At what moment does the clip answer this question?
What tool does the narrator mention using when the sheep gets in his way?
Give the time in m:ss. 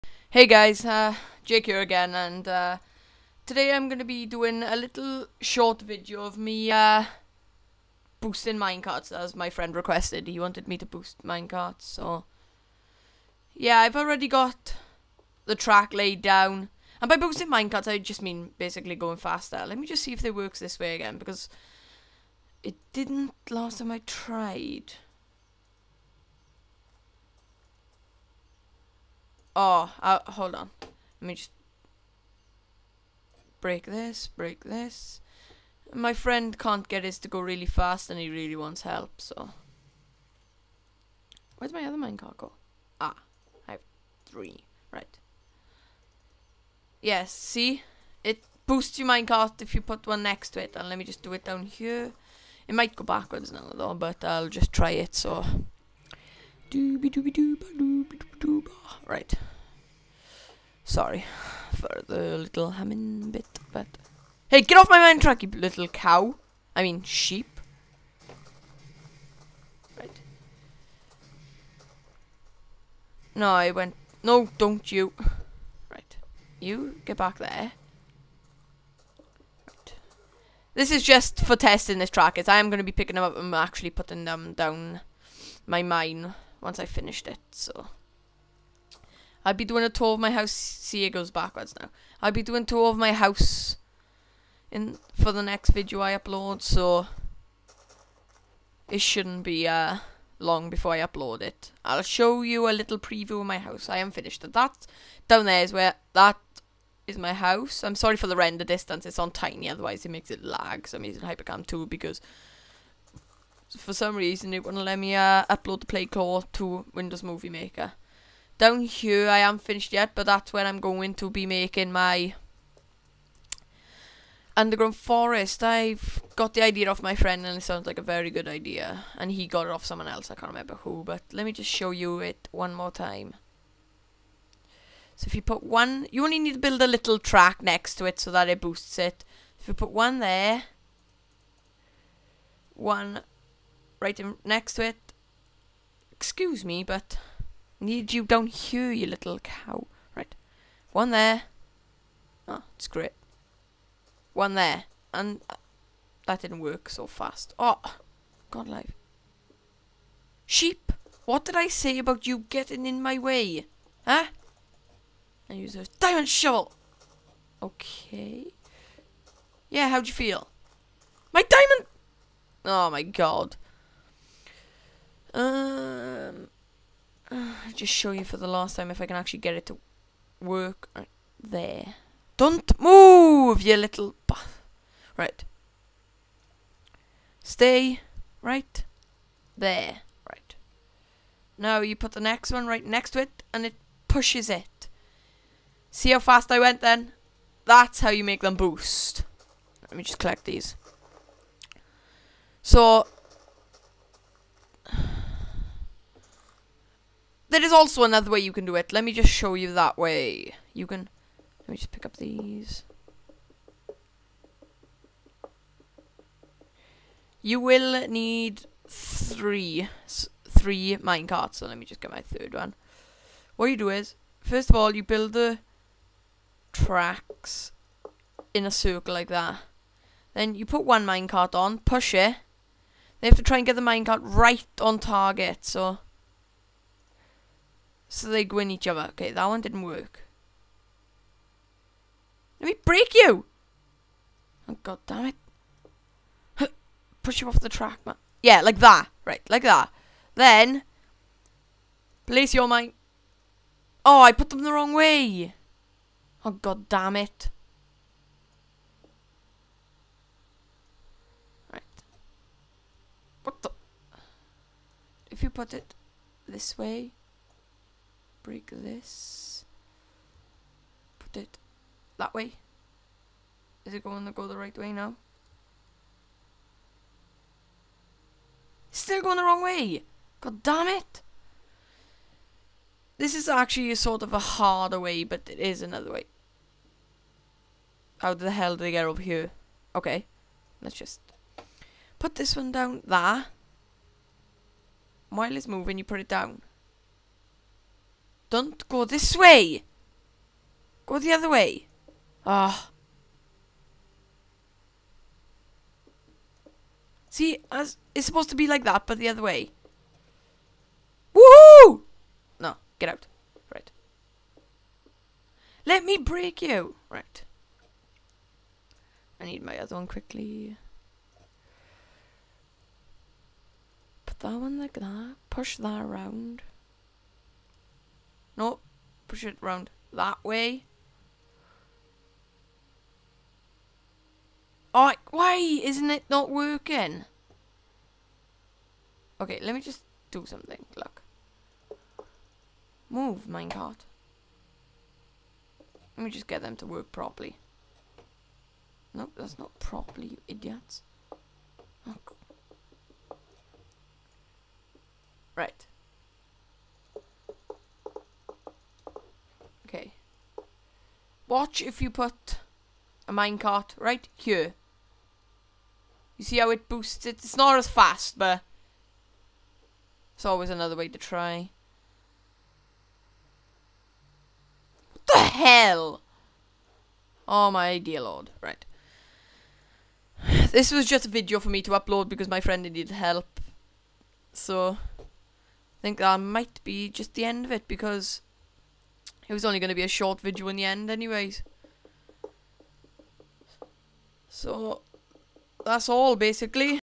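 2:45.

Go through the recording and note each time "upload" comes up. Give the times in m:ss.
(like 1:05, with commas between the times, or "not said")
1:36, 1:40, 1:55, 6:21.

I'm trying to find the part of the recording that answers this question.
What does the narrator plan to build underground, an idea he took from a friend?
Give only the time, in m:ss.
2:04.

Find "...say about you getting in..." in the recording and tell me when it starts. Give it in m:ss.
2:41.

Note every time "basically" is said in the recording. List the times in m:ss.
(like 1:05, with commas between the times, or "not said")
0:18, 6:36.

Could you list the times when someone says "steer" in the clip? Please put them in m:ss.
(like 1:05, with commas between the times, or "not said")
not said.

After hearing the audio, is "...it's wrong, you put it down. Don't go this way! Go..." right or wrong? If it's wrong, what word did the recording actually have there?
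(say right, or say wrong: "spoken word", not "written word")
wrong: "moving", not "wrong".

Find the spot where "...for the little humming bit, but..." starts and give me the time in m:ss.
1:01.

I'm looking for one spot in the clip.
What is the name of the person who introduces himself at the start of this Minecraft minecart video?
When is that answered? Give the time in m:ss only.
0:01.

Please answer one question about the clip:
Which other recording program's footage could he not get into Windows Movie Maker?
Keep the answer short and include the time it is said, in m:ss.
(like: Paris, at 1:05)
PlayClaw, at 1:55.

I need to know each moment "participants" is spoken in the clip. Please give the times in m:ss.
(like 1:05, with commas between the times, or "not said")
not said.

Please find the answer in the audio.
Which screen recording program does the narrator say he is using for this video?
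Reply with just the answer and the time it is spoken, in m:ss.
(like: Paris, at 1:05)
Hypercam 2, at 1:51.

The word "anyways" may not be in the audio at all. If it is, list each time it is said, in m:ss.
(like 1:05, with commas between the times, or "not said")
6:31.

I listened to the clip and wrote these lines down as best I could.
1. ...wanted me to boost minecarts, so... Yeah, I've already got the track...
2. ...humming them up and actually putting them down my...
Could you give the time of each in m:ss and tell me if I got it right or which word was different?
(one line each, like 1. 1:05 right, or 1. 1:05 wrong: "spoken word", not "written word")
1. 0:10 right
2. 1:22 wrong: "picking", not "humming".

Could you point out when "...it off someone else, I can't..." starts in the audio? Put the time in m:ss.
2:09.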